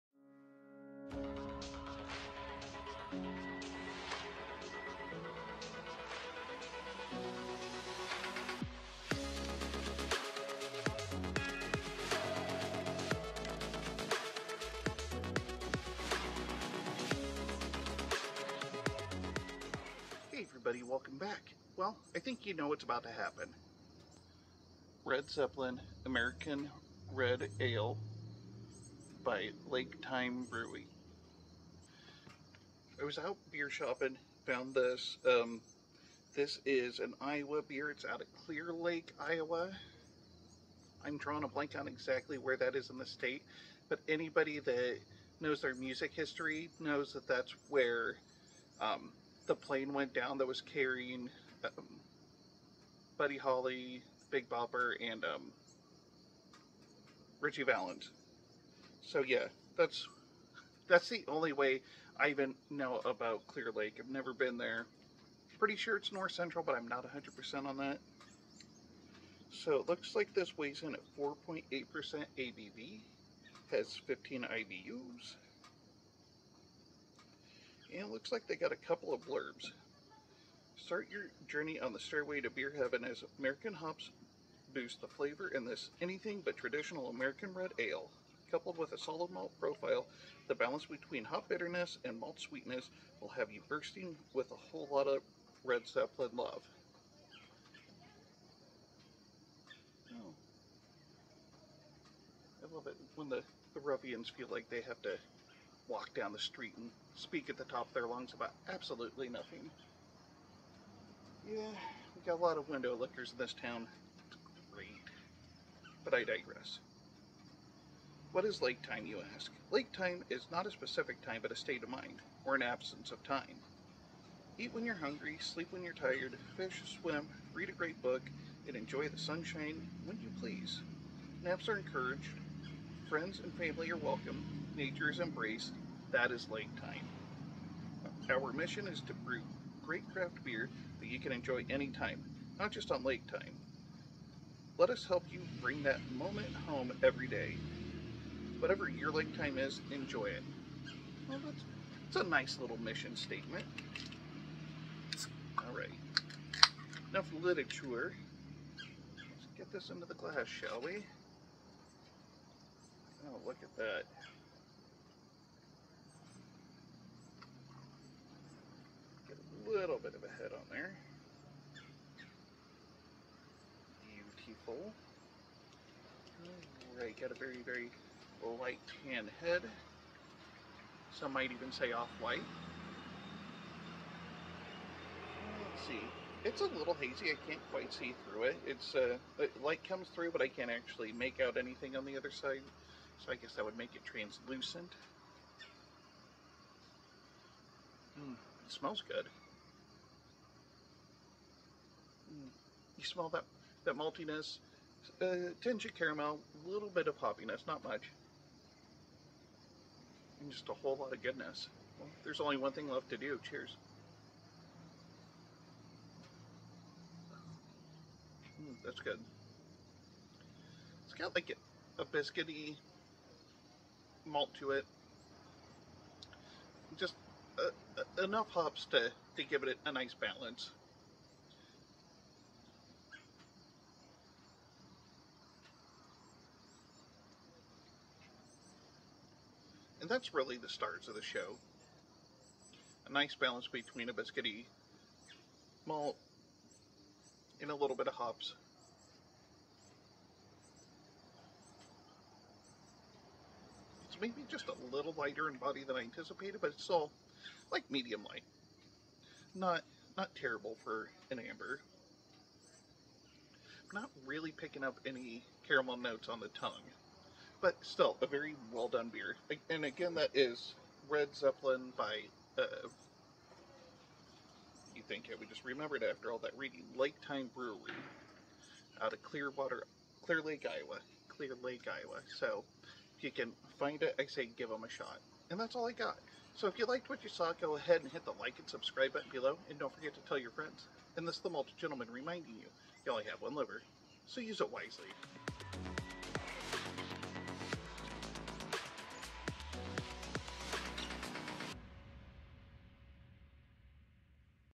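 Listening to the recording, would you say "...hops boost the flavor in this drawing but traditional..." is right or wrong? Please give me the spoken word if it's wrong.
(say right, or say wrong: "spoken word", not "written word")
wrong: "anything", not "drawing".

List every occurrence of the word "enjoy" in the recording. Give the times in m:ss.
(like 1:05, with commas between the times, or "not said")
2:08, 2:21, 2:29.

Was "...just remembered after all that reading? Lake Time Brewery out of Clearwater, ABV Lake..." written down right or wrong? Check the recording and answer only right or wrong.
wrong.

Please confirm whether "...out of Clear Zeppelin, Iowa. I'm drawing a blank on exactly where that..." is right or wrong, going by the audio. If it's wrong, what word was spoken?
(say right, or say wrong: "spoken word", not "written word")
wrong: "Lake", not "Zeppelin".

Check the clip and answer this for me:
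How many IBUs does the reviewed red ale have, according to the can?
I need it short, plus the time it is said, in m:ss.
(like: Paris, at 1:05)
15, at 1:14.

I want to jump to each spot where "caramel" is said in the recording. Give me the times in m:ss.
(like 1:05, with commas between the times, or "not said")
3:25, 4:25.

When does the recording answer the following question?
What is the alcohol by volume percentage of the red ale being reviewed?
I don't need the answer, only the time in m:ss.
1:11.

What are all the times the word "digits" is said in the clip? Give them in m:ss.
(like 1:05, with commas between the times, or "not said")
not said.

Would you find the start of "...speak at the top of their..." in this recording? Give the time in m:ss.
1:47.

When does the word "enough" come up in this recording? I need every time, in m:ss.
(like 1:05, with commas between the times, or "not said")
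2:37, 3:48.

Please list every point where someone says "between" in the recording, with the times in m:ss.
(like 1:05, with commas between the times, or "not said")
1:30, 4:03.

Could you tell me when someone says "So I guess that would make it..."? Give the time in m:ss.
3:13.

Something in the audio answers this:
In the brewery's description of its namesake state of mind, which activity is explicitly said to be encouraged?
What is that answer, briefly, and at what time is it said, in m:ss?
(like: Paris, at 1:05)
Naps, at 2:11.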